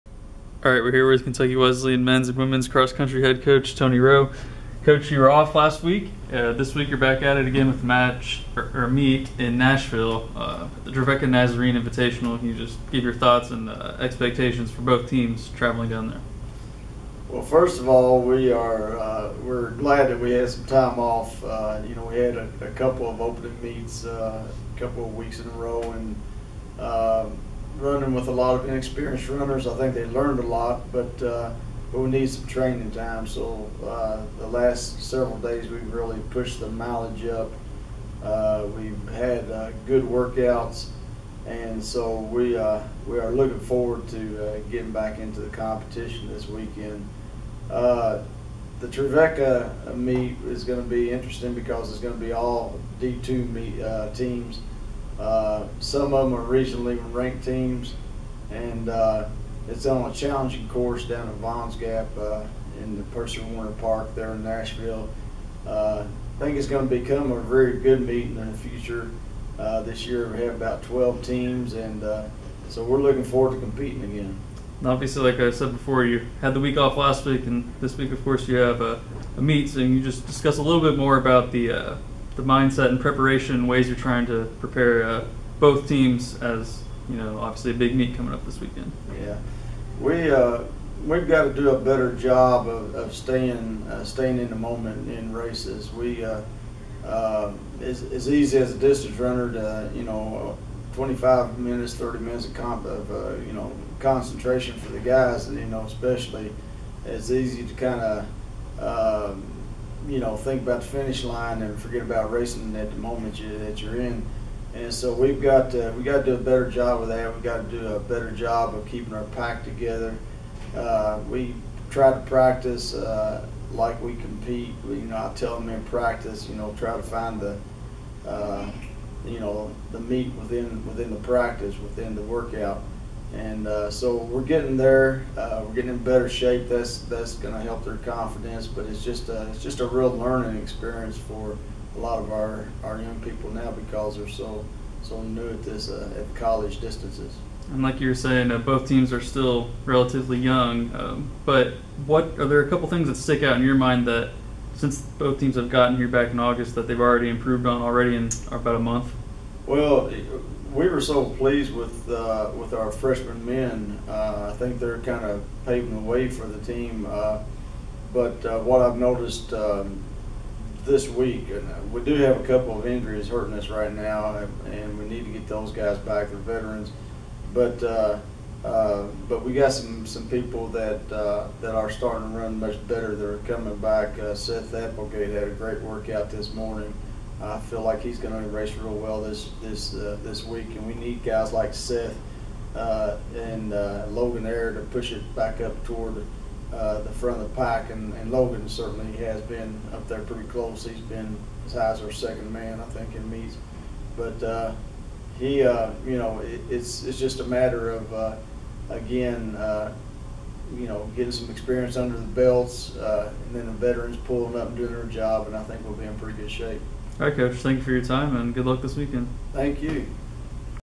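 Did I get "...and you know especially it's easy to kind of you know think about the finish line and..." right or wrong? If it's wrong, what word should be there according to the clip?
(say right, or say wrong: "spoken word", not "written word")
right.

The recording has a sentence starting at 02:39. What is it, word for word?
Well, we were so pleased with uh, with our freshman men.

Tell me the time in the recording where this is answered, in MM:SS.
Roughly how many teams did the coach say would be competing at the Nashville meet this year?
01:10.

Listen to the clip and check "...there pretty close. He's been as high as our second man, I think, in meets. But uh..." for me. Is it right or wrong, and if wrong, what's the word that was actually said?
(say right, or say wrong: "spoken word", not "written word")
right.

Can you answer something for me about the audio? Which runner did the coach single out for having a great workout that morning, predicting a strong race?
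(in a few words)
Seth Applegate.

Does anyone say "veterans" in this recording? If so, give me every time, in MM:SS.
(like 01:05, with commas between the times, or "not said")
02:56, 03:33.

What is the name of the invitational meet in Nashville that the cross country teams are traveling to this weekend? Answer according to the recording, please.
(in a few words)
Trevecca Nazarene Invitational.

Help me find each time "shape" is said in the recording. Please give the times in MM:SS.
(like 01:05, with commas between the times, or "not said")
02:16, 03:36.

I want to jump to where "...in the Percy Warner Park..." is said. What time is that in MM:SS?
01:02.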